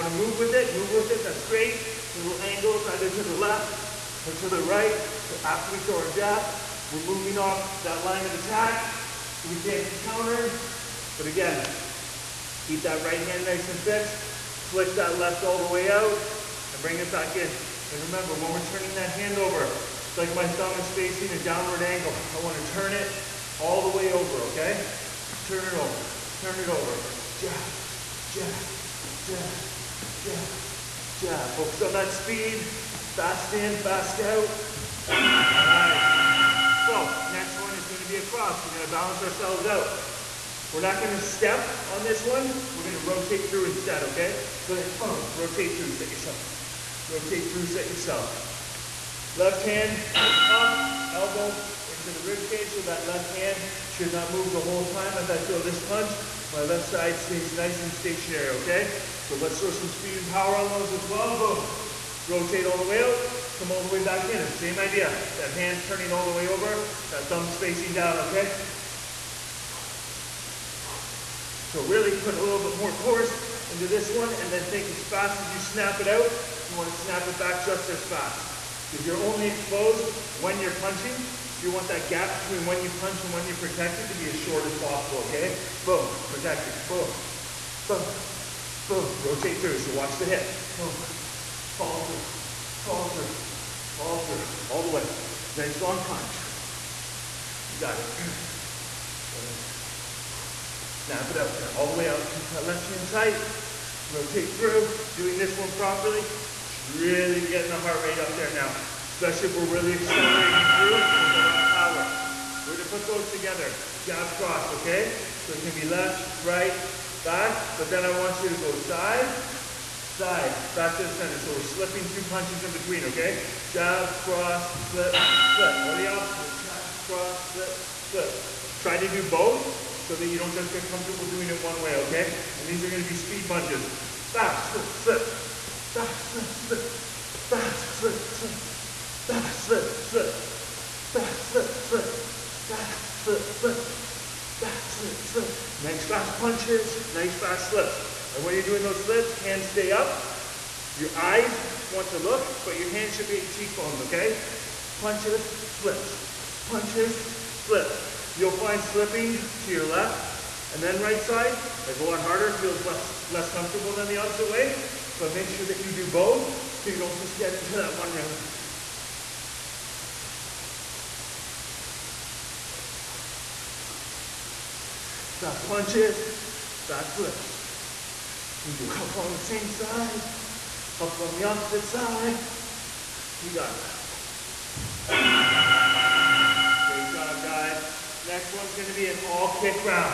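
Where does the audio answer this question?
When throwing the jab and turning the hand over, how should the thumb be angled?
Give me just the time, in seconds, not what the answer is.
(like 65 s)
20 s.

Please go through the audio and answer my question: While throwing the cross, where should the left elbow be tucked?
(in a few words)
into the rib cage.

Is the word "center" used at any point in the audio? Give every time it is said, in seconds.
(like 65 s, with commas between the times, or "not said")
121 s.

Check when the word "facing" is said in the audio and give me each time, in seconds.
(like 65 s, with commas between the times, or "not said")
20 s, 67 s.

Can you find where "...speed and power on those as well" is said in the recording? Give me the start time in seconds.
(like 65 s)
59 s.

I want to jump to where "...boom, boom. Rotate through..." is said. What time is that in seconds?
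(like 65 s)
87 s.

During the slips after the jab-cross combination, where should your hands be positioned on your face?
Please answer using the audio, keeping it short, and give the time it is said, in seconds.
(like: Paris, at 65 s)
at your cheekbones, at 153 s.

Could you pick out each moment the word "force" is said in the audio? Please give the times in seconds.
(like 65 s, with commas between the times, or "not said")
72 s.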